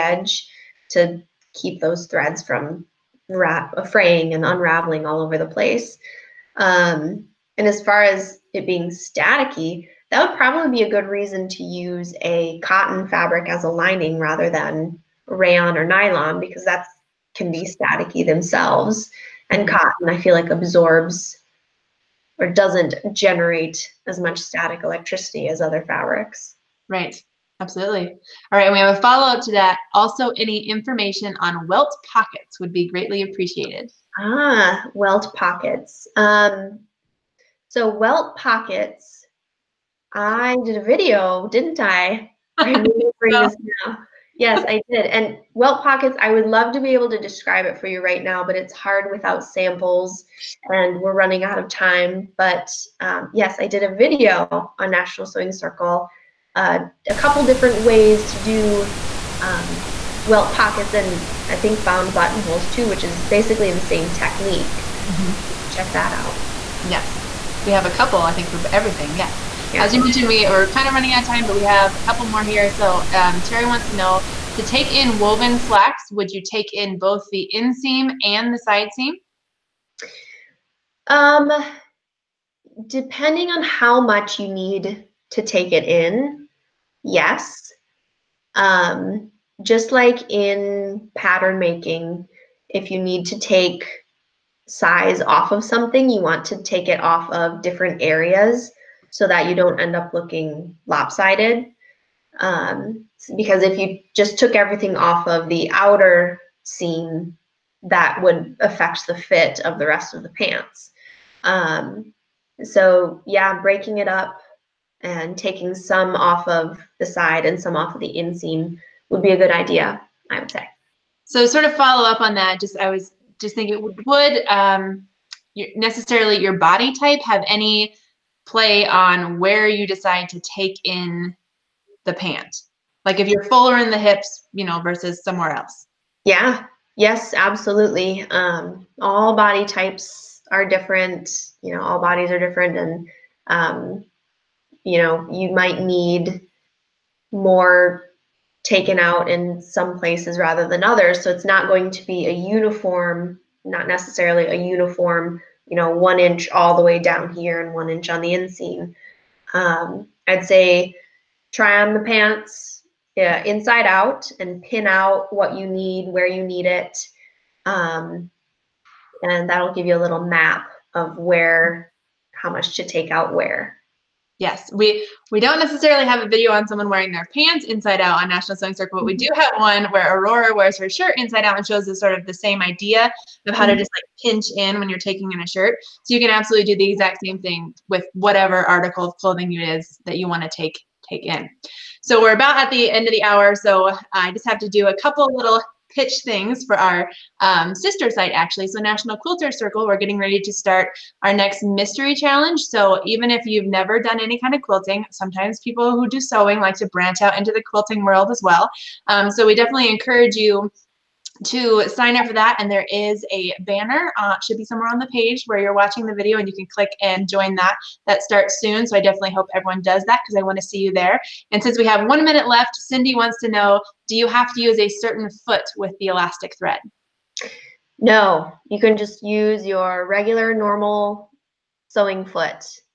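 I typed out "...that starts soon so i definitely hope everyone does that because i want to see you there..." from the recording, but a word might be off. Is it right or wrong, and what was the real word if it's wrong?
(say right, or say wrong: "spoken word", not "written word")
right.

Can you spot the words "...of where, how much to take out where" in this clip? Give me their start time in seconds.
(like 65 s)
170 s.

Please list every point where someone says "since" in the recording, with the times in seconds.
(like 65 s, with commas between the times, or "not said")
221 s.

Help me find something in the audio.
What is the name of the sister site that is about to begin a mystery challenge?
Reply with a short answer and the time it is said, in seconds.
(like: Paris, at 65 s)
National Quilter Circle, at 198 s.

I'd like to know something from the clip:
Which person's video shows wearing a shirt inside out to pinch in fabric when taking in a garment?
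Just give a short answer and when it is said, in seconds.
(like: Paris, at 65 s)
Aurora, at 180 s.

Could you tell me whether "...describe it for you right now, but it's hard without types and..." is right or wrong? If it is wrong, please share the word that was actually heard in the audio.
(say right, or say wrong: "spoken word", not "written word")
wrong: "samples", not "types".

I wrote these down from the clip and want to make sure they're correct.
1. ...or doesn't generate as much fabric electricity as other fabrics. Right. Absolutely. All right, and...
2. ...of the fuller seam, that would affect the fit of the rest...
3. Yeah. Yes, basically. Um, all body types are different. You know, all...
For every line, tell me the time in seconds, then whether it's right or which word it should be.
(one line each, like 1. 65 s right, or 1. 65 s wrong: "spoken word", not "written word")
1. 22 s wrong: "static", not "fabric"
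2. 105 s wrong: "outer", not "fuller"
3. 136 s wrong: "absolutely", not "basically".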